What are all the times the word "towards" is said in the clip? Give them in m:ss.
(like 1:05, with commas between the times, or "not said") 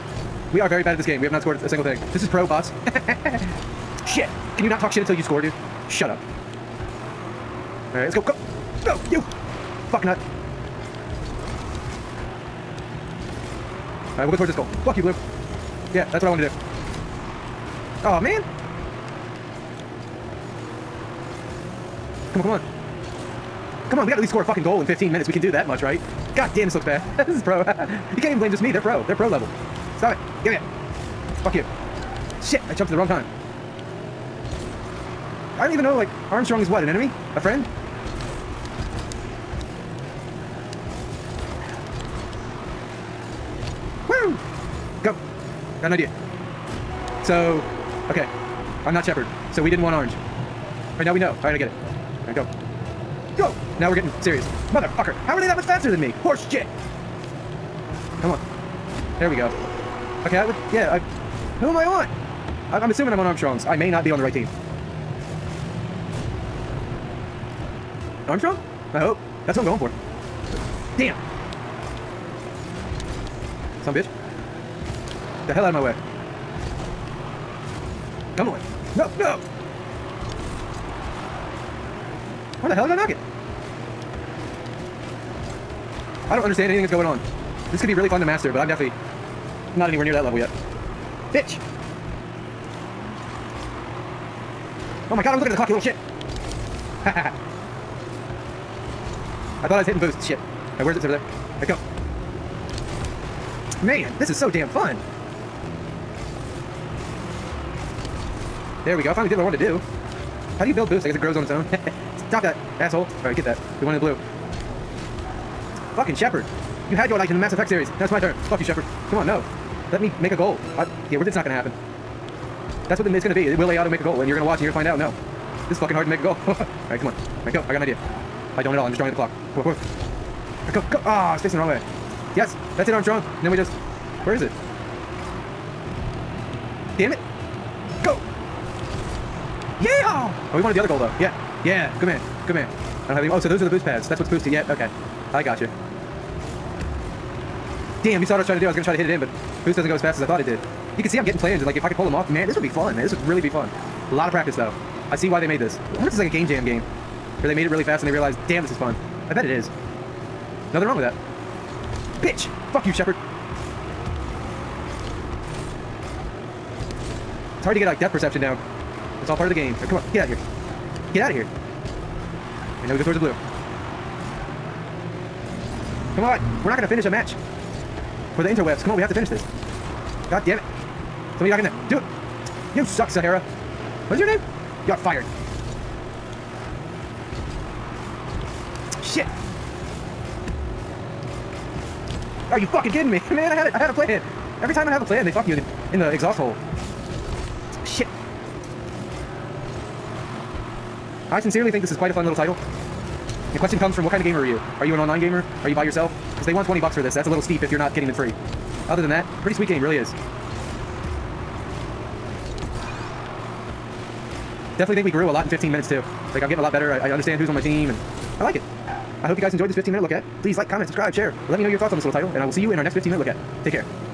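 0:14, 2:53.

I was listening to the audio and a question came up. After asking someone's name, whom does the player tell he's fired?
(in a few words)
Sahara.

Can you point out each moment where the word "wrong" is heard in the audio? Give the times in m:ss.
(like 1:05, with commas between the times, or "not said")
0:32, 2:11, 2:40.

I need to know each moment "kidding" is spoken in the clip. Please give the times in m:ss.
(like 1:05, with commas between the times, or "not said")
3:12.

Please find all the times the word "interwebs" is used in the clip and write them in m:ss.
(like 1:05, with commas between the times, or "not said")
2:58.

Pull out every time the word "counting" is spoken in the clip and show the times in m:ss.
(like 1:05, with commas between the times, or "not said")
not said.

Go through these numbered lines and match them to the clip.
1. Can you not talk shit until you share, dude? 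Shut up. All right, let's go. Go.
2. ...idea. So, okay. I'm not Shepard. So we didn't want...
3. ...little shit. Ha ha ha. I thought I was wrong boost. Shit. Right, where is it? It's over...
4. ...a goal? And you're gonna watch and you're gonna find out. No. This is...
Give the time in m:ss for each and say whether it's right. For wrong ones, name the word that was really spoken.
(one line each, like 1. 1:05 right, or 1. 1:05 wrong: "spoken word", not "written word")
1. 0:04 wrong: "score", not "share"
2. 0:45 right
3. 1:35 wrong: "hitting", not "wrong"
4. 2:04 right.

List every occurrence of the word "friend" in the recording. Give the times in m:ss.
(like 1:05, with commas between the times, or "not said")
0:37.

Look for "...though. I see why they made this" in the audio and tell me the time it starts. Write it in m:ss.
2:34.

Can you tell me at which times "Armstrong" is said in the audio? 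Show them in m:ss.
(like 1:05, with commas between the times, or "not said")
0:36, 1:03, 1:08, 2:12.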